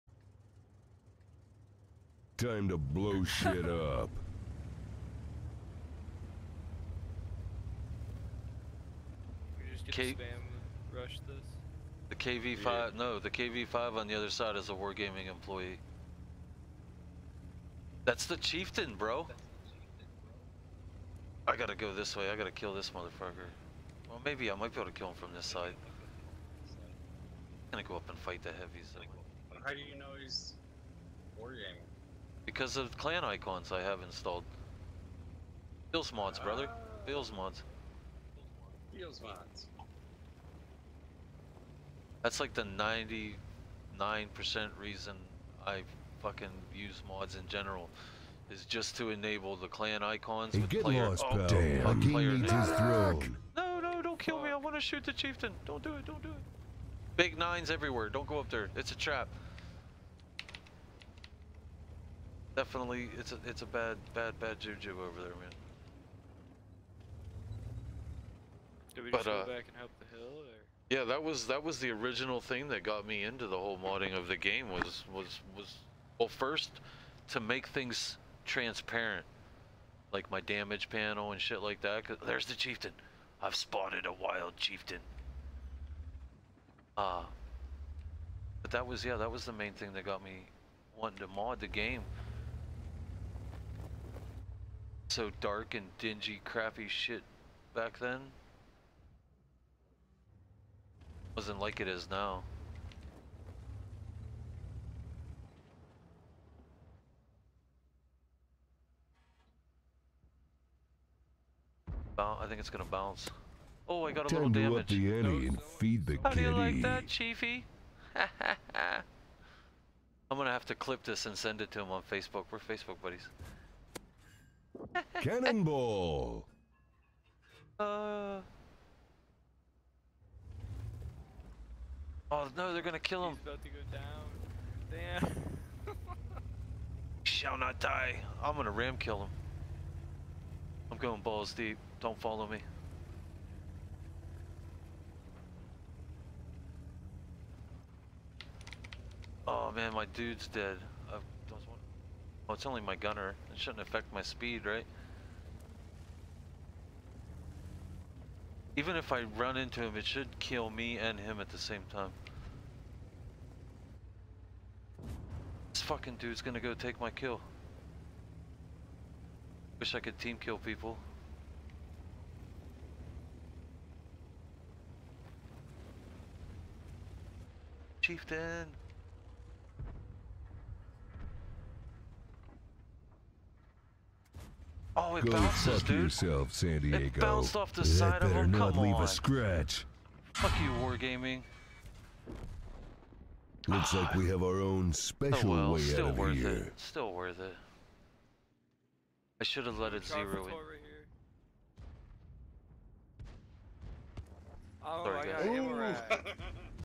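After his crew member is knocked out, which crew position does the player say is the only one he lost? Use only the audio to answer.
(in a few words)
gunner.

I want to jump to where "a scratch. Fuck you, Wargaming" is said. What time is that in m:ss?
3:09.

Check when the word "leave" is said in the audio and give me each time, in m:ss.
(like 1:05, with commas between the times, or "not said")
3:08.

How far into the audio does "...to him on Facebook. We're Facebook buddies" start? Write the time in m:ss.
2:01.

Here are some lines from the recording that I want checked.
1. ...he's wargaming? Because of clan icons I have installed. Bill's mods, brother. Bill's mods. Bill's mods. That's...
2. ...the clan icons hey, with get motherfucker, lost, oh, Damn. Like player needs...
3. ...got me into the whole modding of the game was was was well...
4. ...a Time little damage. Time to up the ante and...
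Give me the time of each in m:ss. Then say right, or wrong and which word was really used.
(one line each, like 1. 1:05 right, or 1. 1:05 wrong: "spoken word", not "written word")
1. 0:30 right
2. 0:49 wrong: "player", not "motherfucker"
3. 1:12 right
4. 1:54 right.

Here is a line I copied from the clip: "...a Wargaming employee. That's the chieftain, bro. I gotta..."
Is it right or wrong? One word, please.
right.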